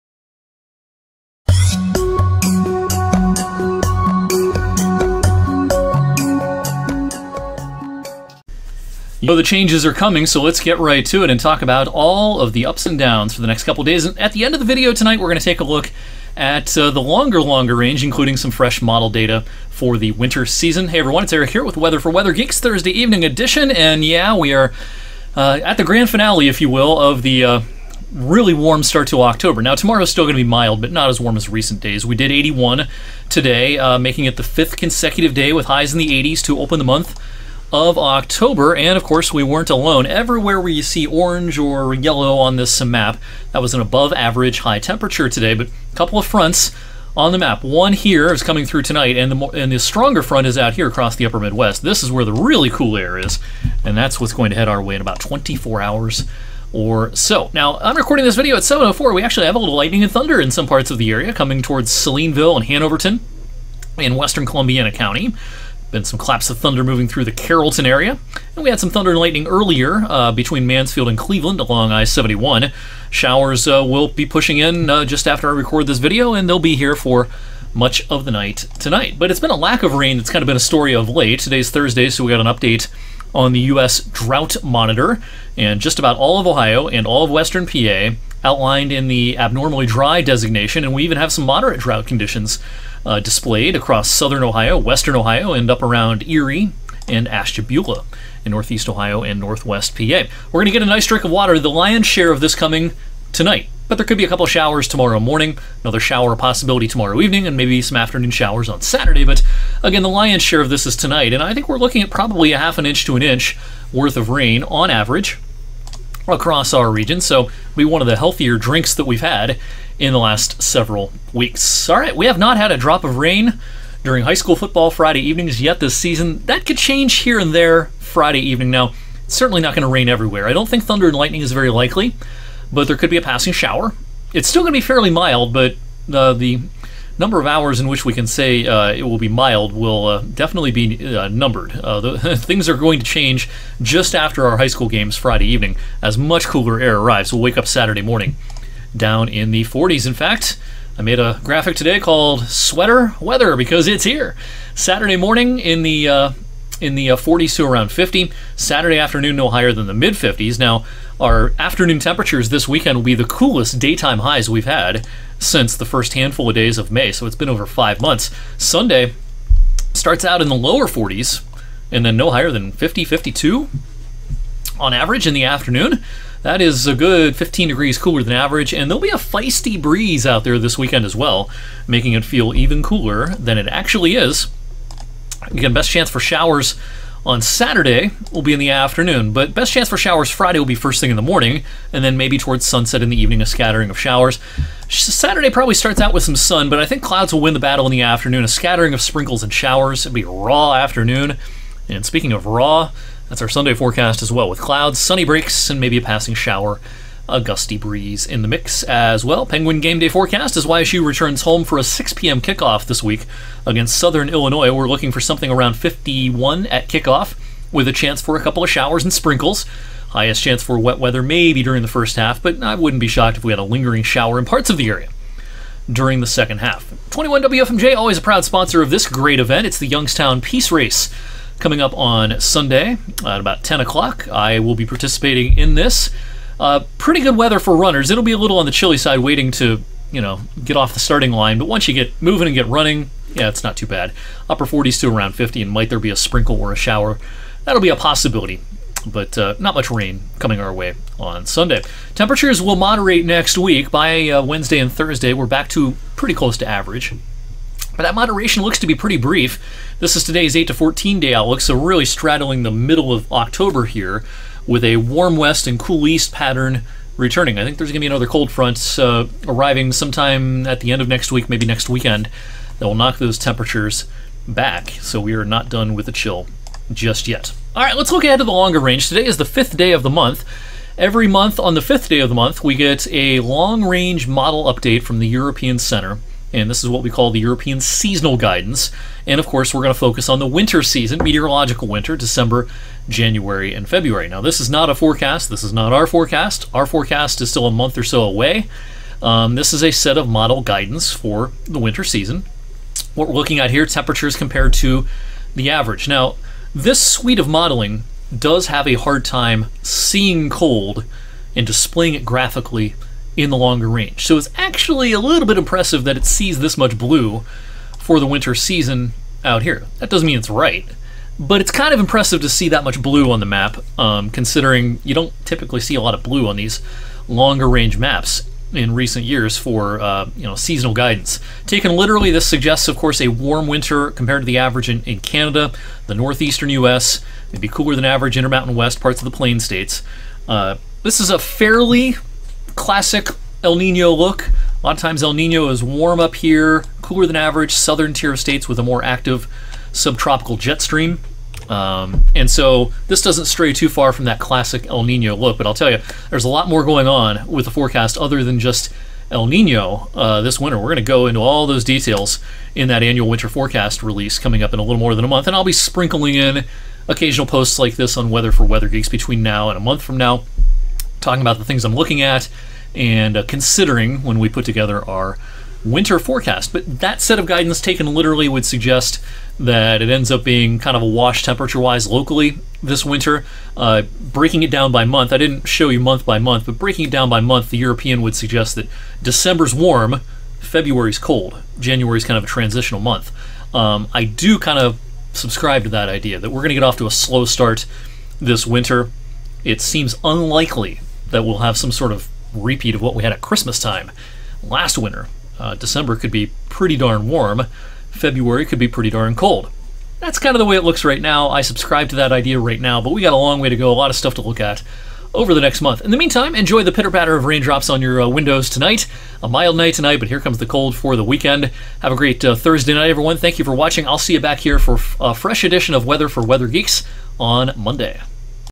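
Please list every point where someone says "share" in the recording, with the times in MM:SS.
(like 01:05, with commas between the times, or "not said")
01:42, 01:50.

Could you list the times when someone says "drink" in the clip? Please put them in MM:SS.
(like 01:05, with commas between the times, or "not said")
01:41, 01:58.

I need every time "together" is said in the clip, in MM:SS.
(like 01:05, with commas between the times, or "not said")
06:14.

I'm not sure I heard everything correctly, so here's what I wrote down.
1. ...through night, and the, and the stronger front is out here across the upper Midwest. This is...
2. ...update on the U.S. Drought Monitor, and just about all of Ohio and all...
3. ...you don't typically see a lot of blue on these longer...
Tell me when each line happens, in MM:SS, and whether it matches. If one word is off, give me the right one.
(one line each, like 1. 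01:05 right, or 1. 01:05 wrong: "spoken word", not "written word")
1. 00:48 wrong: "tonight", not "night"
2. 01:22 right
3. 05:25 right.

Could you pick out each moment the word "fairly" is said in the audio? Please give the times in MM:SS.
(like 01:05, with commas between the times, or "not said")
02:14, 05:41.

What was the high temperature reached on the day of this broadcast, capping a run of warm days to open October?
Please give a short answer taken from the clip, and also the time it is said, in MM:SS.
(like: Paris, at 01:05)
81, at 00:32.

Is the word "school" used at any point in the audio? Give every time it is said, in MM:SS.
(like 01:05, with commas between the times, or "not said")
02:04, 02:24.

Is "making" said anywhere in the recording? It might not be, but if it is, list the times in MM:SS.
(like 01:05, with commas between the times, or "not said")
00:33, 03:01.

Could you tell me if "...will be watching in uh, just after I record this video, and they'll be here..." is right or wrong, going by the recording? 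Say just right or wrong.
wrong.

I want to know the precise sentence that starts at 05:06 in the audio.
Now, this suite of modeling does have a hard time seeing cold and displaying it graphically in the longer range.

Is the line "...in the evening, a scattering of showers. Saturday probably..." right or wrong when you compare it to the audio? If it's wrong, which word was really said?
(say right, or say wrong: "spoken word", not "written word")
right.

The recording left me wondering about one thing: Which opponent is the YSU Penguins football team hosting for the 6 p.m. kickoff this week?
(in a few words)
Southern Illinois.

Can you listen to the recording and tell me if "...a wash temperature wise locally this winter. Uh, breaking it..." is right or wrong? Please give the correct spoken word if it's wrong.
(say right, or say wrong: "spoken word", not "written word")
right.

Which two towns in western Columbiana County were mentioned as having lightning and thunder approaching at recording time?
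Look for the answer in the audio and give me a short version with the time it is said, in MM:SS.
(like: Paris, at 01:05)
Salineville and Hanoverton, at 01:01.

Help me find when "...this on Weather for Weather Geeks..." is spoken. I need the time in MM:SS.
06:07.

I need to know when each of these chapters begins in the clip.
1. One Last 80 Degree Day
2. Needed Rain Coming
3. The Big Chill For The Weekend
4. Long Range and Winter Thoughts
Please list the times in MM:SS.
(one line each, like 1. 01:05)
1. 00:20
2. 01:00
3. 02:30
4. 04:15.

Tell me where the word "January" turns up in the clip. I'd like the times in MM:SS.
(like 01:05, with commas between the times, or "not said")
04:53, 06:31.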